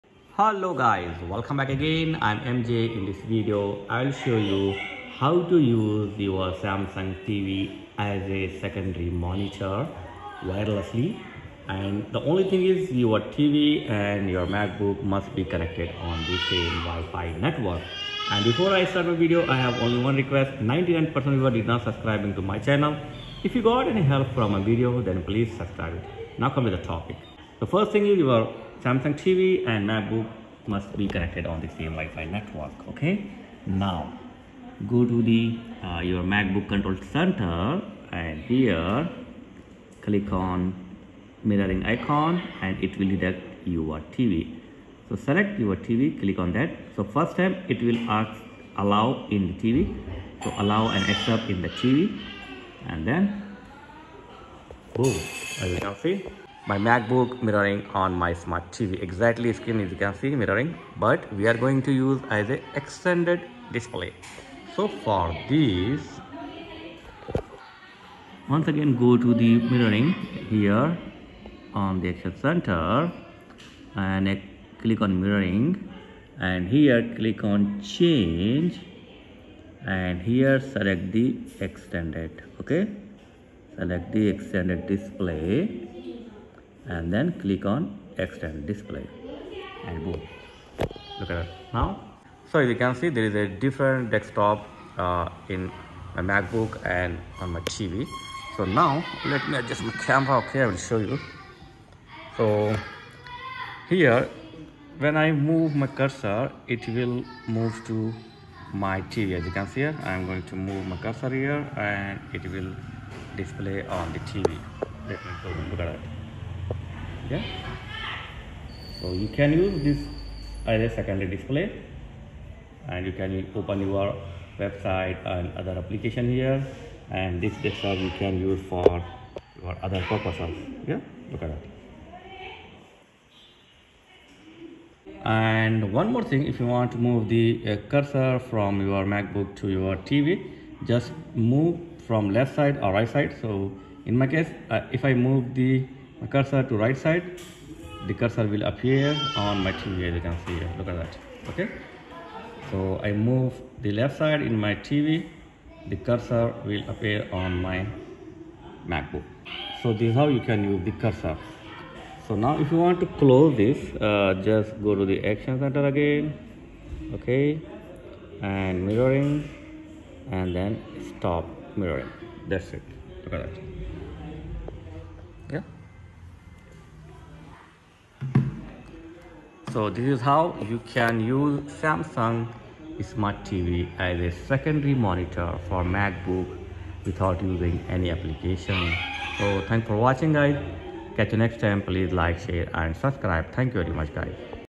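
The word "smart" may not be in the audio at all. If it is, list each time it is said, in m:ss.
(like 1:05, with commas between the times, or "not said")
0:58, 3:03.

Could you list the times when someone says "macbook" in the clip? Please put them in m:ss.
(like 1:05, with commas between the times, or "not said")
0:14, 0:29, 0:36, 0:56, 1:36, 2:19, 2:38, 3:05.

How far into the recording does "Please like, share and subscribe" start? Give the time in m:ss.
3:11.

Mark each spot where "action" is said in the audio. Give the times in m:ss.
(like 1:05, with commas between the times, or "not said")
1:12, 2:45.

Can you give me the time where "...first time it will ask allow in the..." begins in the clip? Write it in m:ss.
0:47.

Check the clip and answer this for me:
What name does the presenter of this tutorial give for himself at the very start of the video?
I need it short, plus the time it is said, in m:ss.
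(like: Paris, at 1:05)
MJ, at 0:02.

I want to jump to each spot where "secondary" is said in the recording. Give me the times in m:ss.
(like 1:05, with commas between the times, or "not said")
0:08, 2:00, 3:04.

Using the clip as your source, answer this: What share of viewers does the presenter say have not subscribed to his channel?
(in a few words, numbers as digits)
99 percent.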